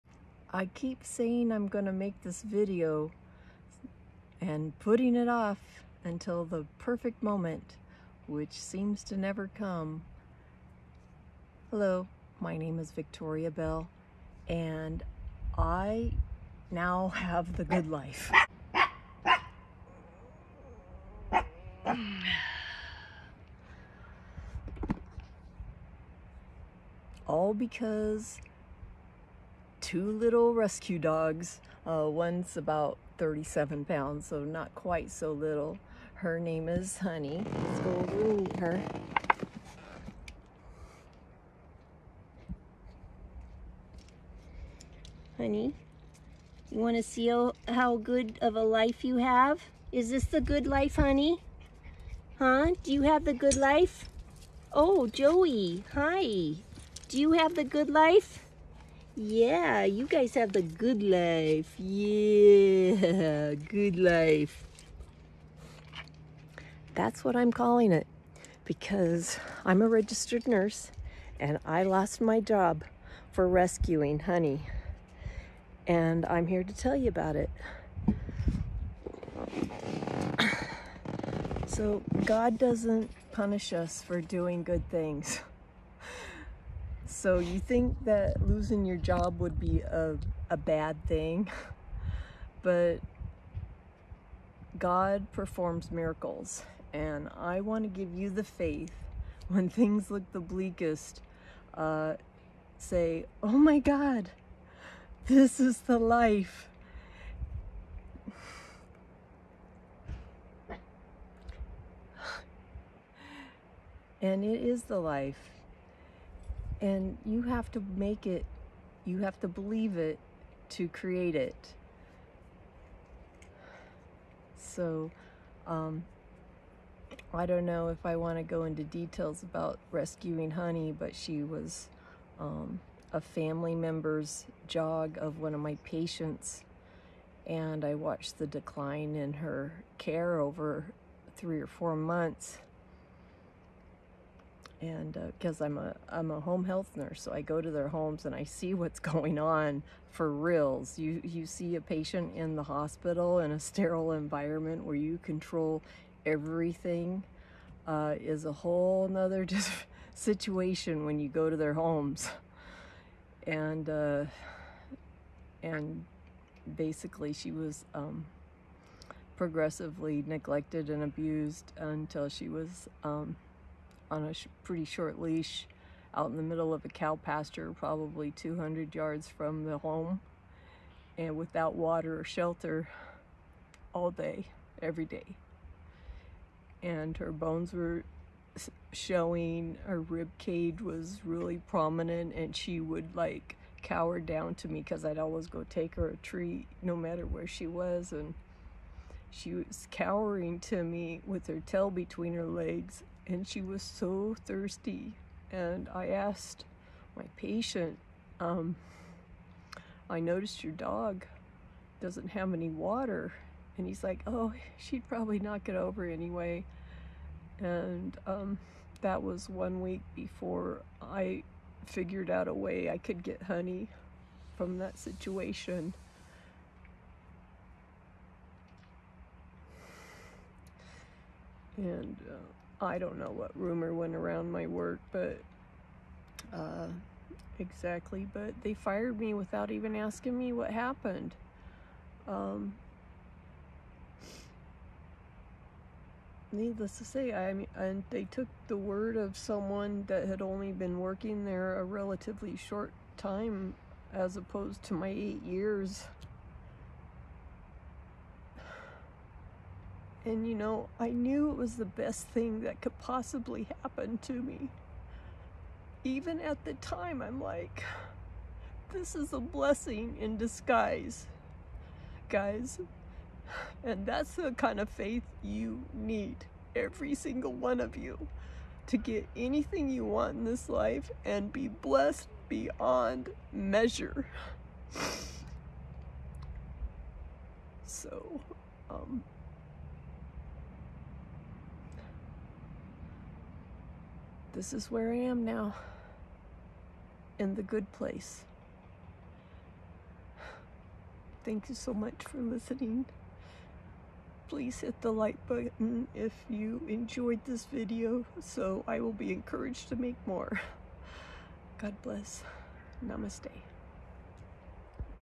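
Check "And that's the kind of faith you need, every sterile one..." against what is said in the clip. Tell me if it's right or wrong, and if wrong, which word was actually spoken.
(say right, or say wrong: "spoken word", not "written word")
wrong: "single", not "sterile".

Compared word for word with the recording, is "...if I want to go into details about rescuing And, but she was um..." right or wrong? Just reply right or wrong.
wrong.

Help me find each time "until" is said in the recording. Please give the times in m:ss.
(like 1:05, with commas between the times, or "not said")
0:06, 2:51.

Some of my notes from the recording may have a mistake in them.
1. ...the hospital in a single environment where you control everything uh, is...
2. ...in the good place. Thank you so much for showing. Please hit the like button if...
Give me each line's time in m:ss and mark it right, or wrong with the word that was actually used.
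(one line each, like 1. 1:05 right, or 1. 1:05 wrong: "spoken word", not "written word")
1. 2:32 wrong: "sterile", not "single"
2. 4:57 wrong: "listening", not "showing".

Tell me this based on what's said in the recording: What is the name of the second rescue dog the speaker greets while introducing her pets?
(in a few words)
Joey.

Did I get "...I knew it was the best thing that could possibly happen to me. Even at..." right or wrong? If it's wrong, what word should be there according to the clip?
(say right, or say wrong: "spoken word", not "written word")
right.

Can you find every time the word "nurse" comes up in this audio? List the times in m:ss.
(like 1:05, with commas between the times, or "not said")
1:10, 2:26.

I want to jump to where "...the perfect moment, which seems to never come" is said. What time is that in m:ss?
0:06.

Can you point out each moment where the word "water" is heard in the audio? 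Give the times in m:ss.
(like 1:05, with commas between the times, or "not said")
3:01, 3:32.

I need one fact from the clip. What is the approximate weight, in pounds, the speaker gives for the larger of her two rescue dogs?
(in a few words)
37 pounds.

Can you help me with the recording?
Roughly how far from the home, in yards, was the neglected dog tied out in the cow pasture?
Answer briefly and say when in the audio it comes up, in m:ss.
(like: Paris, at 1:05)
200 yards, at 2:58.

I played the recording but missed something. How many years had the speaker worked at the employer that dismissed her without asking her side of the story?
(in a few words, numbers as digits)
8.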